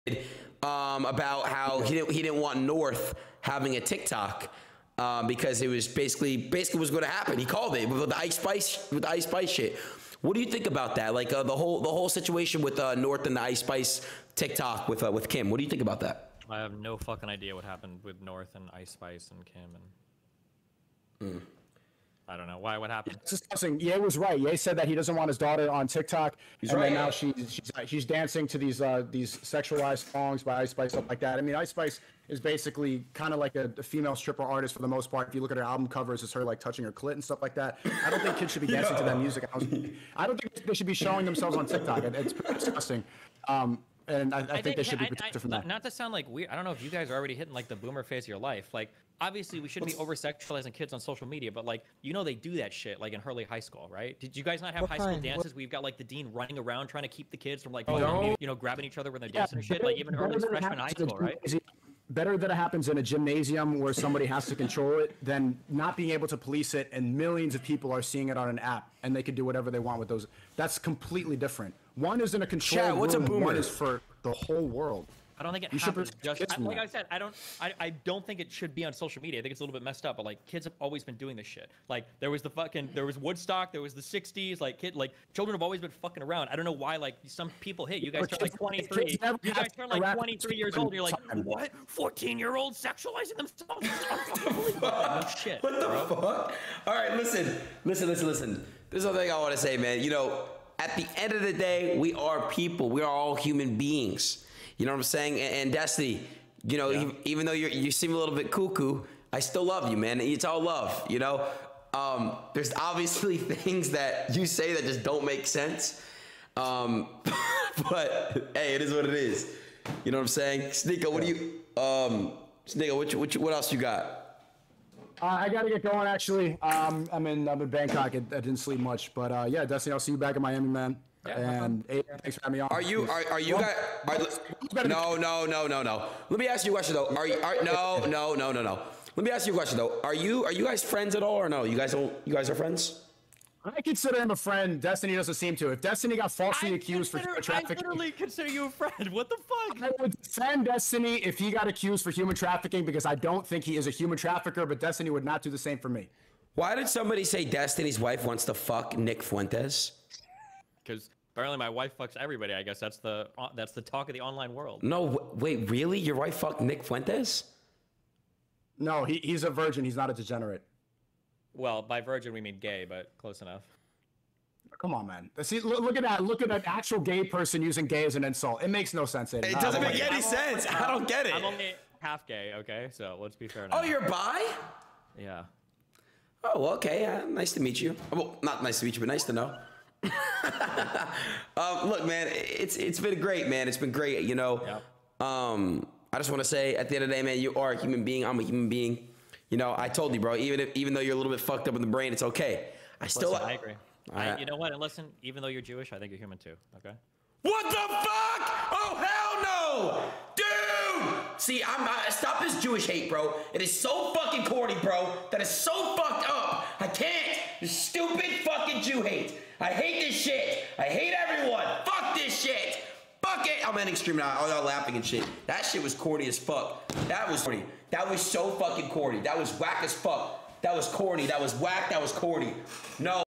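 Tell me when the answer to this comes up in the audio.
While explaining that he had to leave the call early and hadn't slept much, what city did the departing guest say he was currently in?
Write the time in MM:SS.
02:07.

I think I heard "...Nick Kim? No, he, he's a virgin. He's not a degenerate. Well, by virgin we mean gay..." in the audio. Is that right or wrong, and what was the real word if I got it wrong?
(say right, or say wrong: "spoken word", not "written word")
wrong: "Fuentes", not "Kim".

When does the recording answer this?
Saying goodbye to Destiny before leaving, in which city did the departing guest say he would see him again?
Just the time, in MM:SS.
02:10.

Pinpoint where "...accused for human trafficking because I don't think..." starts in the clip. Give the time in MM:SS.
02:31.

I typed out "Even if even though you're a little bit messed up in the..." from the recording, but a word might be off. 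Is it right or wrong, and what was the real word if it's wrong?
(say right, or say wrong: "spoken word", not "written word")
wrong: "fucked", not "messed".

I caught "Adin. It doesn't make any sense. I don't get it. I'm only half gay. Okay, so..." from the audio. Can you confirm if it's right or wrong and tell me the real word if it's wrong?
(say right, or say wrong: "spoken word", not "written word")
right.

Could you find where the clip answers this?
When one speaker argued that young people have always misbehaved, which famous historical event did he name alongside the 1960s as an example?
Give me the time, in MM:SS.
01:23.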